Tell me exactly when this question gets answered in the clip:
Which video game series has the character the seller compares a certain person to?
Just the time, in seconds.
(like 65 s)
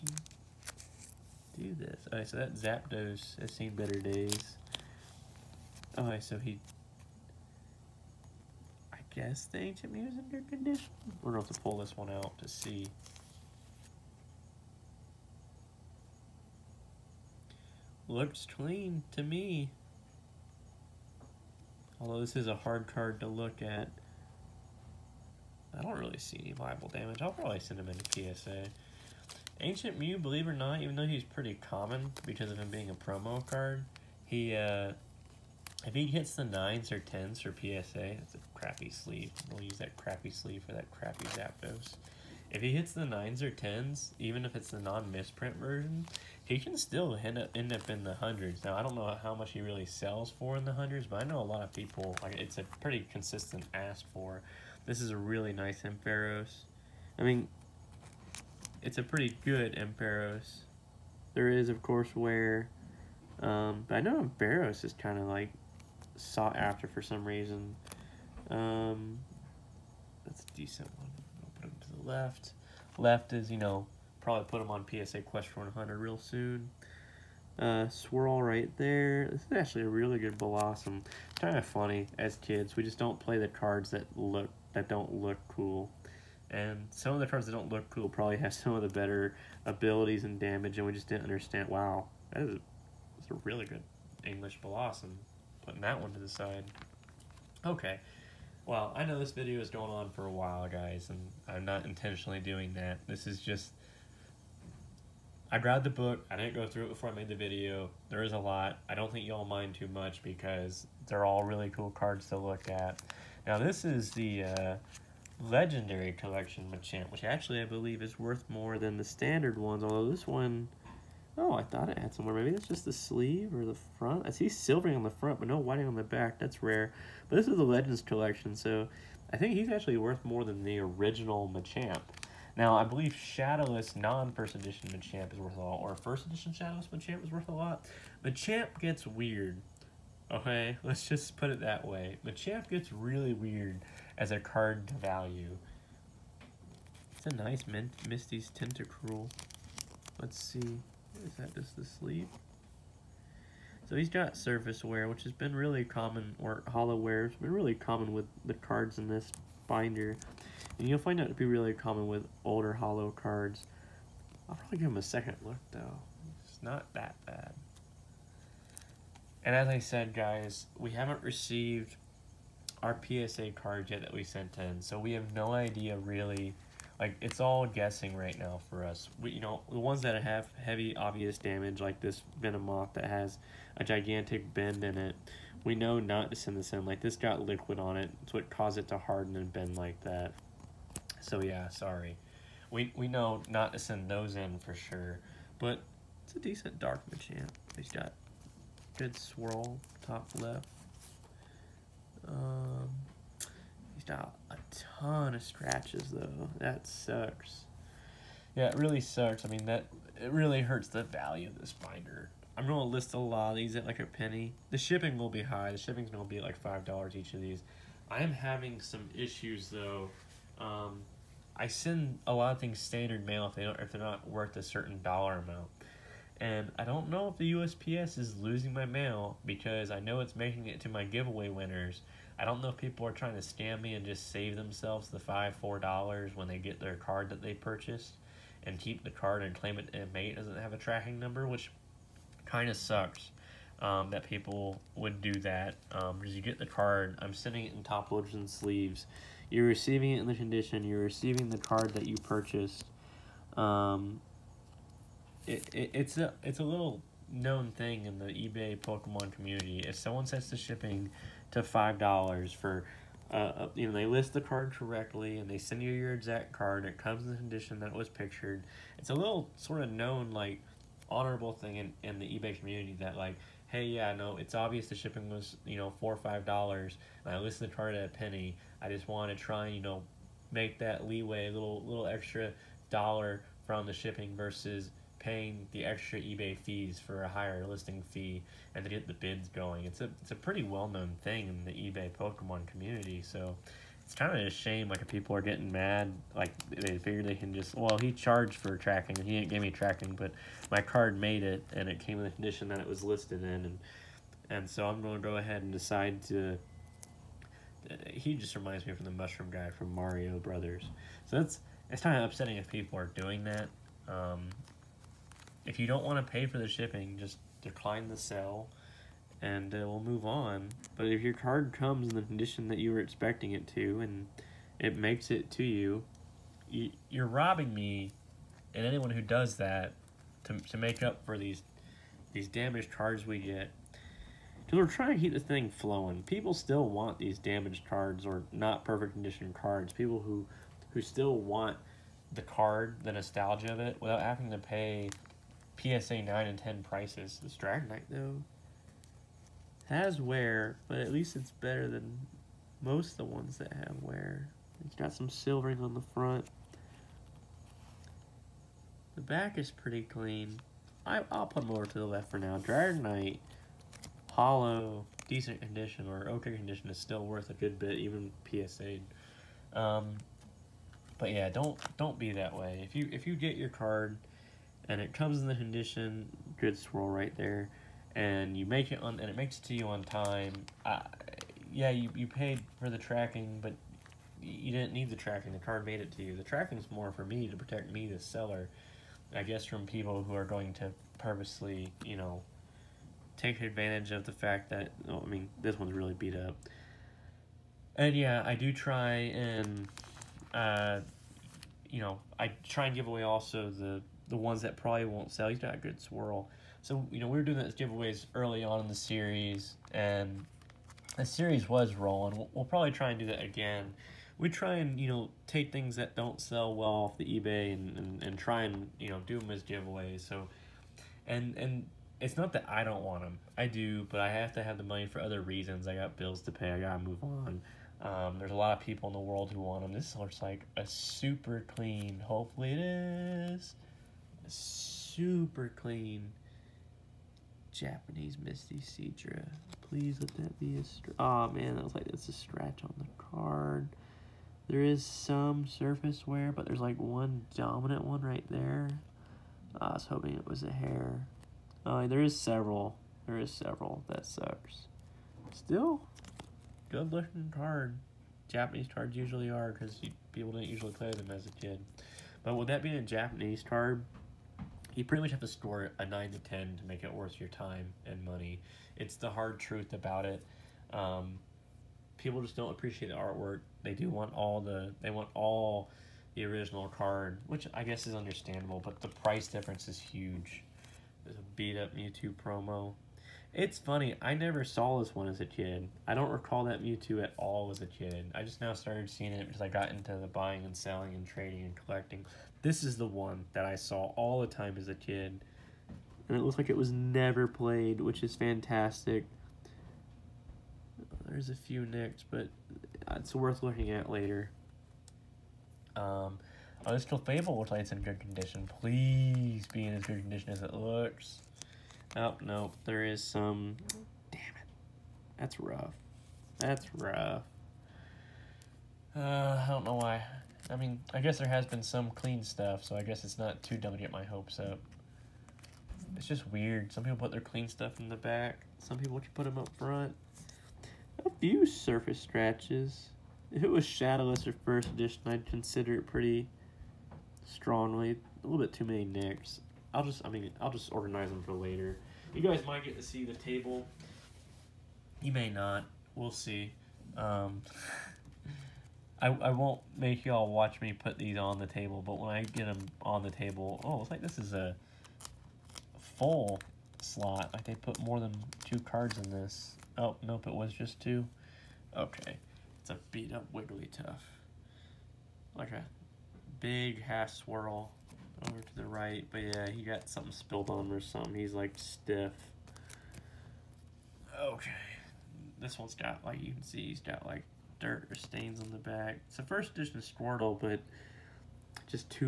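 309 s.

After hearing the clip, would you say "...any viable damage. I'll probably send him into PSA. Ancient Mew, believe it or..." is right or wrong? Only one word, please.
right.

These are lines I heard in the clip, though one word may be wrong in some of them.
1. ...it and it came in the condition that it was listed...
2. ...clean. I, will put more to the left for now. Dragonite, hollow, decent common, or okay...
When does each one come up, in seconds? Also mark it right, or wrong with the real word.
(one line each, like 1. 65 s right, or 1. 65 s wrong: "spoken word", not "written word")
1. 301 s right
2. 360 s wrong: "condition", not "common".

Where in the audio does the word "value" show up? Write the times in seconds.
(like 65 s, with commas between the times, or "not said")
145 s, 211 s.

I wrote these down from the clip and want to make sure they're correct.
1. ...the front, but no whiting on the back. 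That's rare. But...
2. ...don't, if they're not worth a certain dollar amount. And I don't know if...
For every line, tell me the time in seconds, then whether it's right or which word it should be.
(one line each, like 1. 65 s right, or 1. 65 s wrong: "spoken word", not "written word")
1. 125 s right
2. 223 s right.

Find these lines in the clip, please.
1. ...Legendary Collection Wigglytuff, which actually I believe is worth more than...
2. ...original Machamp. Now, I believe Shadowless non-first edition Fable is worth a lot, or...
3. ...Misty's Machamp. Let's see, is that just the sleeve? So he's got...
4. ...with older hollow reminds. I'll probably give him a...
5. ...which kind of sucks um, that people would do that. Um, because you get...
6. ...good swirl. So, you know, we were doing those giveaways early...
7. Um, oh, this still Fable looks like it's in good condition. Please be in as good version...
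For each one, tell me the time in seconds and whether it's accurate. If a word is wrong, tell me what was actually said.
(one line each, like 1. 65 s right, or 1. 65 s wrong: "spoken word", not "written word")
1. 115 s wrong: "Machamp", not "Wigglytuff"
2. 130 s wrong: "Machamp", not "Fable"
3. 148 s wrong: "Tentacruel", not "Machamp"
4. 162 s wrong: "cards", not "reminds"
5. 241 s right
6. 405 s right
7. 505 s wrong: "condition", not "version".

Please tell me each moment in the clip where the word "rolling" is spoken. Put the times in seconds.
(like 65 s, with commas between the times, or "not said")
411 s.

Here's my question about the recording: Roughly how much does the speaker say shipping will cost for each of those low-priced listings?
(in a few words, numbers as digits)
$5.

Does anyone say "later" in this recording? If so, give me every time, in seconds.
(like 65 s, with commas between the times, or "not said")
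504 s, 541 s.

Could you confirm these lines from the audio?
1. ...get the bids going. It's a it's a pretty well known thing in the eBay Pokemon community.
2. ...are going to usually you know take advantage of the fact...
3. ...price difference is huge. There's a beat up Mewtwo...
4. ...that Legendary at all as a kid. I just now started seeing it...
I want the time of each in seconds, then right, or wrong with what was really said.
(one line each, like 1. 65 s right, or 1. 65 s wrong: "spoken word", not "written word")
1. 288 s right
2. 390 s wrong: "purposely", not "usually"
3. 479 s right
4. 486 s wrong: "Mewtwo", not "Legendary".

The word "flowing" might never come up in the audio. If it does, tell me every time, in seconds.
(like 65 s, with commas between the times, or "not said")
335 s.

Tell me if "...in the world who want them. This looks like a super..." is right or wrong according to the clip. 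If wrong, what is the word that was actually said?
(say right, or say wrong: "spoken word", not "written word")
right.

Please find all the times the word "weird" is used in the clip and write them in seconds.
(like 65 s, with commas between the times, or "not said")
139 s, 143 s, 526 s.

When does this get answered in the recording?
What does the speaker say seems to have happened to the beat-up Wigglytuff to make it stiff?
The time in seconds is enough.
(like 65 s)
569 s.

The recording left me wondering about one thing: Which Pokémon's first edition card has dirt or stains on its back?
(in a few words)
Squirtle.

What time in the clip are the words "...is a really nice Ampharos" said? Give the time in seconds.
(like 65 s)
55 s.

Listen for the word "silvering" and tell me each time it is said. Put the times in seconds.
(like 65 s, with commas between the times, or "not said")
124 s, 355 s.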